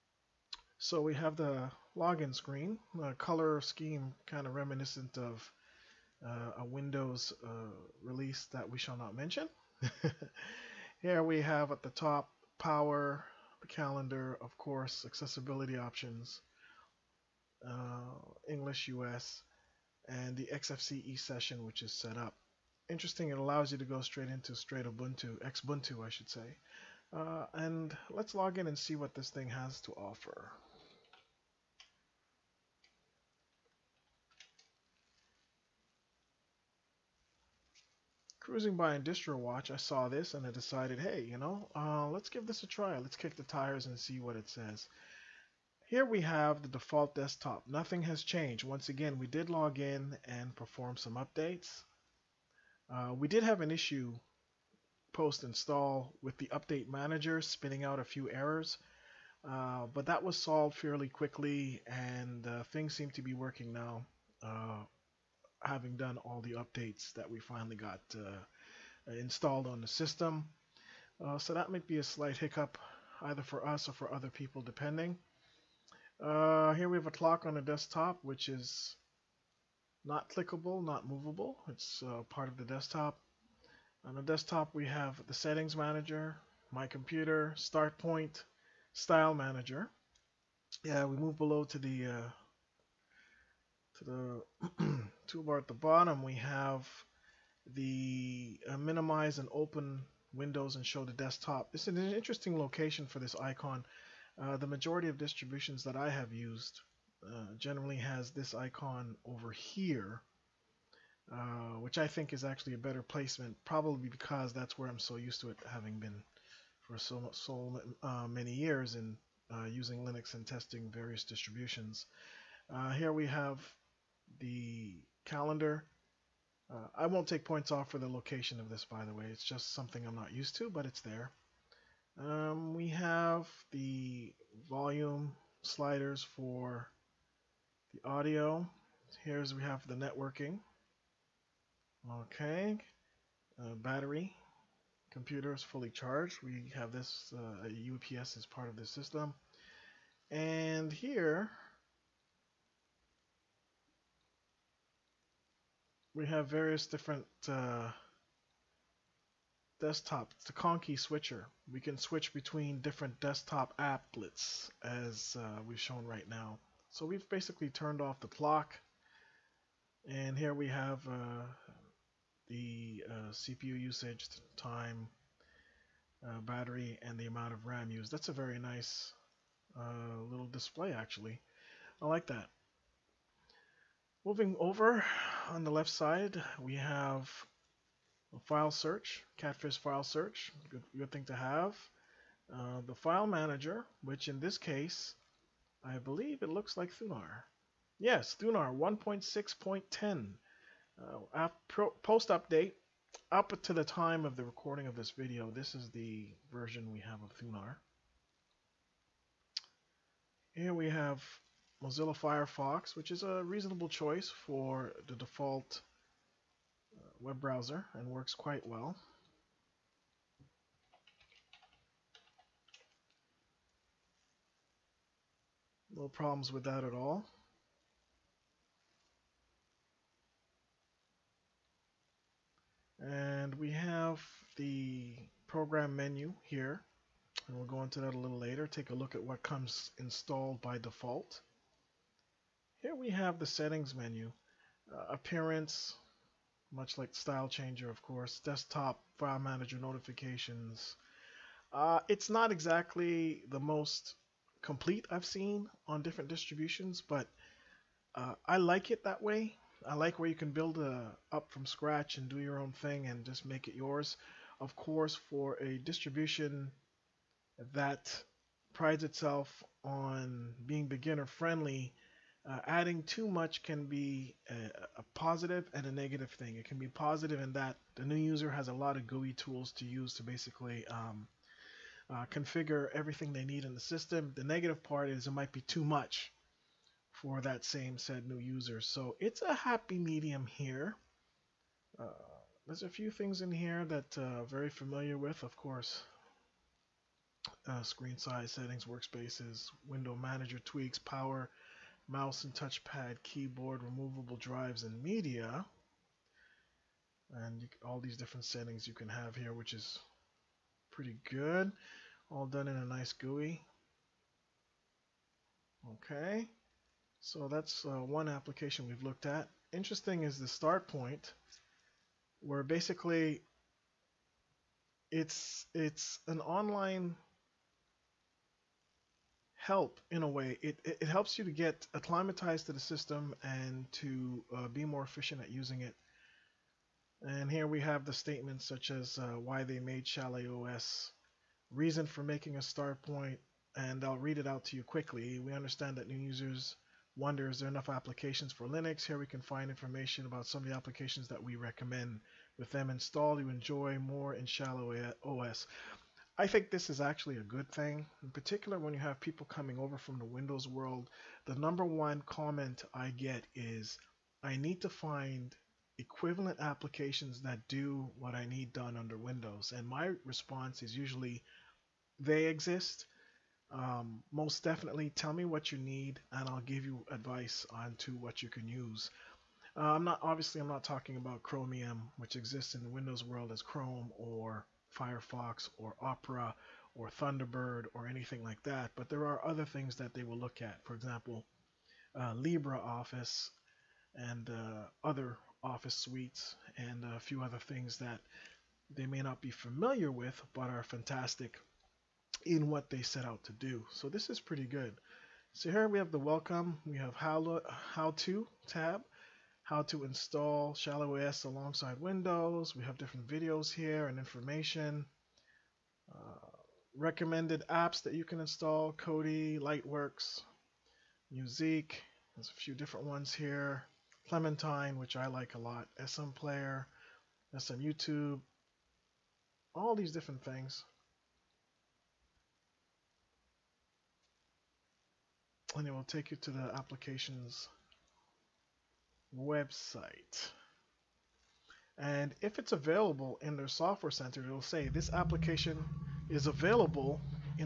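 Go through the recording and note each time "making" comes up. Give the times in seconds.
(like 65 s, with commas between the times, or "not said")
342 s.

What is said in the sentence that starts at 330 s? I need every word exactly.
It, it, it, helps you to get acclimatized to the system and to uh, be more efficient at using it.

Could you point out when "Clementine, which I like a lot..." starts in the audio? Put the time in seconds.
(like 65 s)
424 s.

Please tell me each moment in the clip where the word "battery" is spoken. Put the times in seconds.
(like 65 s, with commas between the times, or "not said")
143 s, 176 s.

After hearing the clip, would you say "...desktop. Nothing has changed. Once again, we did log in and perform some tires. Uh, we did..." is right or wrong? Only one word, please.
wrong.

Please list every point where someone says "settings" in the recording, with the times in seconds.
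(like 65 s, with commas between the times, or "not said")
85 s, 243 s, 298 s, 308 s.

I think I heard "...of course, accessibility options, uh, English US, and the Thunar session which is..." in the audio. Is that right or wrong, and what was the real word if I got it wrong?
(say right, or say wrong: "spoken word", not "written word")
wrong: "XFCE", not "Thunar".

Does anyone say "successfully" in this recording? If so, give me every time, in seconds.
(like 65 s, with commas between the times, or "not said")
not said.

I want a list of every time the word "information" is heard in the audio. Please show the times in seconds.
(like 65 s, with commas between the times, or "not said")
349 s, 414 s.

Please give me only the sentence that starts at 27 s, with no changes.
Uh, and let's log in and see what this thing has to offer.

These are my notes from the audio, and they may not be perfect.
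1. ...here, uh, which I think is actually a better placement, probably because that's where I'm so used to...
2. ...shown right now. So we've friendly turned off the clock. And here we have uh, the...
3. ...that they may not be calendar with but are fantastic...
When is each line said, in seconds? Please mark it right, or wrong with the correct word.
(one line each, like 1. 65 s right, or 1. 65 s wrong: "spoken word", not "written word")
1. 109 s right
2. 165 s wrong: "basically", not "friendly"
3. 397 s wrong: "familiar", not "calendar".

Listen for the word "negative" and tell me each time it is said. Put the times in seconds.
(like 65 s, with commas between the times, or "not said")
275 s, 284 s.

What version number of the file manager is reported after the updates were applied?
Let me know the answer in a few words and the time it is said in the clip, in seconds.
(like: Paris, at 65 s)
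1.6.10, at 198 s.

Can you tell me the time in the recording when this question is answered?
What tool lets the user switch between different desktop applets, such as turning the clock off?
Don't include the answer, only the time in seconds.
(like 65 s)
160 s.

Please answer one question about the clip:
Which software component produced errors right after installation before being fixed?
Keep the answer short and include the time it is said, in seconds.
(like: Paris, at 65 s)
update manager, at 56 s.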